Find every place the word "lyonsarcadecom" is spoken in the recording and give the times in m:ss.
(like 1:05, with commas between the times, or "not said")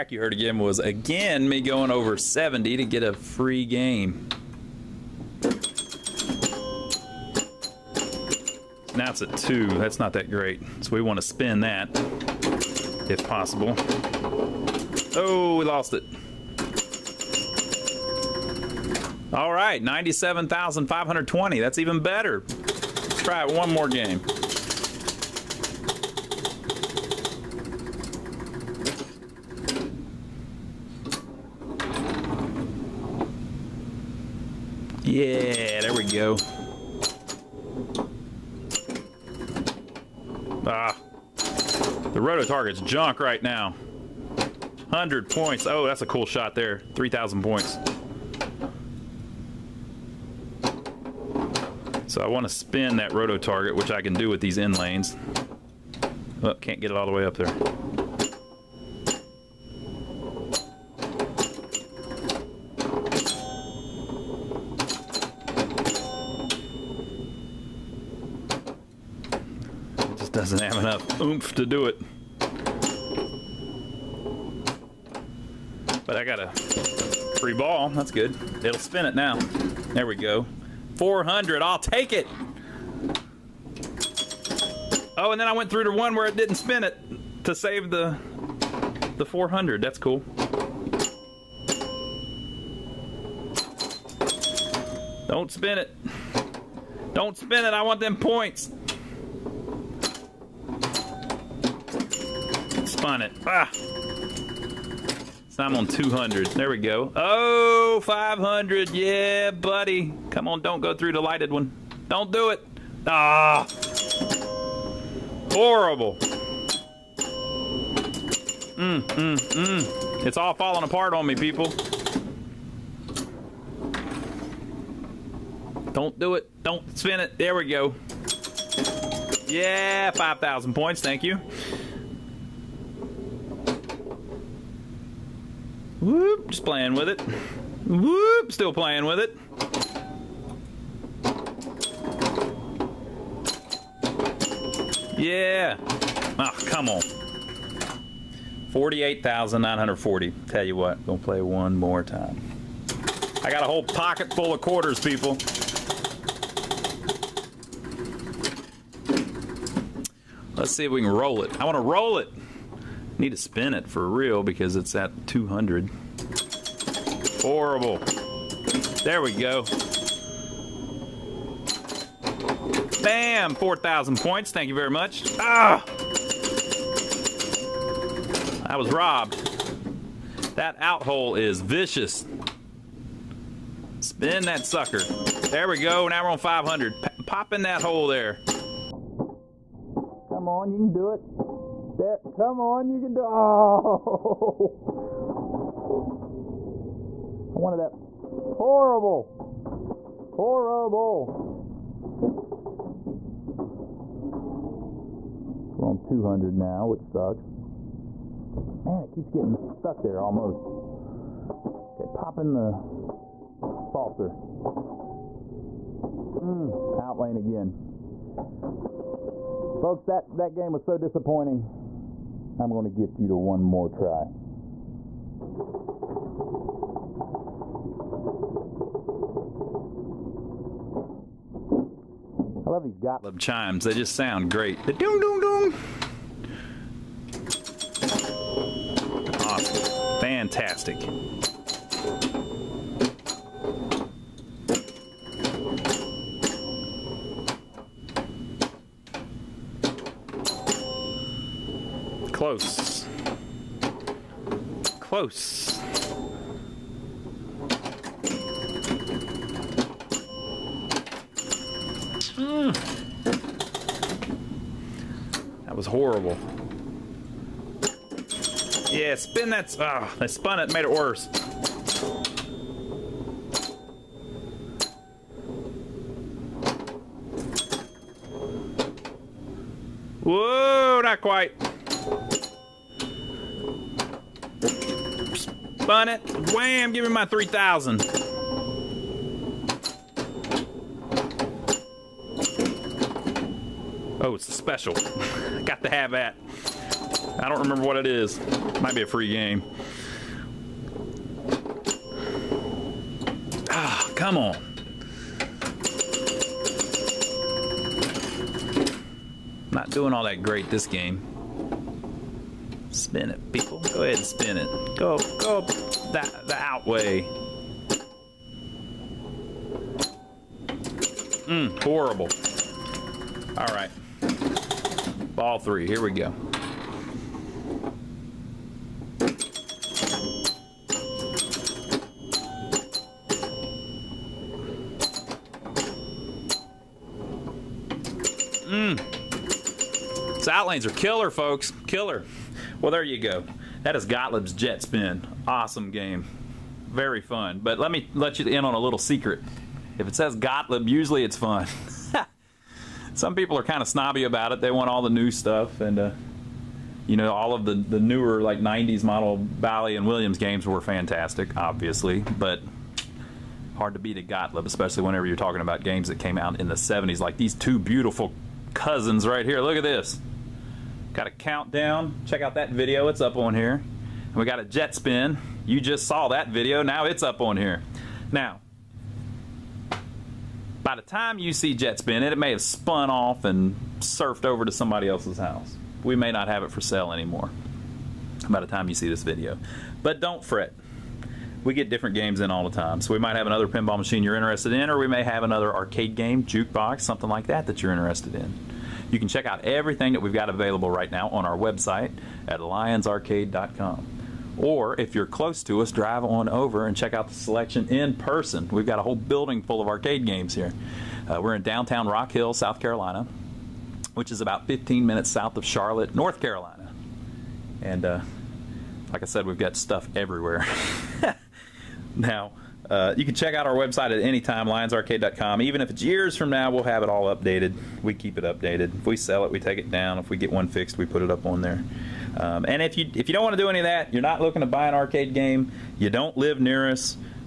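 6:42, 7:04.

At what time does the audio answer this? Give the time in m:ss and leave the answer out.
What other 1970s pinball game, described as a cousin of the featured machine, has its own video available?
6:11.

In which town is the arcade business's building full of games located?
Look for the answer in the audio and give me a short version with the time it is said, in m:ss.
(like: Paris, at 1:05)
Rock Hill, South Carolina, at 6:52.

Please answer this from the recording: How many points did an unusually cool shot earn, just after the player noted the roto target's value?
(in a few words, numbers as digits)
3,000.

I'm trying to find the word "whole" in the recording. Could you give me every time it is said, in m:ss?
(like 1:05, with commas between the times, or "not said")
2:33, 6:49.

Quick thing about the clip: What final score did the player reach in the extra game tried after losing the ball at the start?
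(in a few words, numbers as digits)
97,520.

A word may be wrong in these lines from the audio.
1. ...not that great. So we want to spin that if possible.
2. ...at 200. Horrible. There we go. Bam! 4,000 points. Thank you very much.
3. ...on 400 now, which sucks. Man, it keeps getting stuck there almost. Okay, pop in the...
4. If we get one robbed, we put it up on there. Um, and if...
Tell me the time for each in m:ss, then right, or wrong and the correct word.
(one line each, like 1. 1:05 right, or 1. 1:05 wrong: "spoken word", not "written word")
1. 0:09 right
2. 2:44 right
3. 3:25 wrong: "200", not "400"
4. 7:10 wrong: "fixed", not "robbed".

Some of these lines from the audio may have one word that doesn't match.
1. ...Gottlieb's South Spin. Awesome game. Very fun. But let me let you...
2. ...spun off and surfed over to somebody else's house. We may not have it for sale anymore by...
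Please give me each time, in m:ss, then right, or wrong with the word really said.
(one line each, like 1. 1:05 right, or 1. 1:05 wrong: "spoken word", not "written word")
1. 5:44 wrong: "Jet", not "South"
2. 6:22 right.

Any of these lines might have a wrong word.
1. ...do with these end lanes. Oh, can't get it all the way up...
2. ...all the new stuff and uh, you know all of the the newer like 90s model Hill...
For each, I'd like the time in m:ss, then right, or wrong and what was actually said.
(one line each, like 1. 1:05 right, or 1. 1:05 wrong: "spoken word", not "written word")
1. 0:54 right
2. 5:54 wrong: "Bally", not "Hill".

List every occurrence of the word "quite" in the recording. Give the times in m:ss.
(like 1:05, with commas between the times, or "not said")
4:41.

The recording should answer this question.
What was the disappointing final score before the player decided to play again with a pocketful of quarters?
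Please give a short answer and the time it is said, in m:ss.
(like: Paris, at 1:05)
48,940, at 2:28.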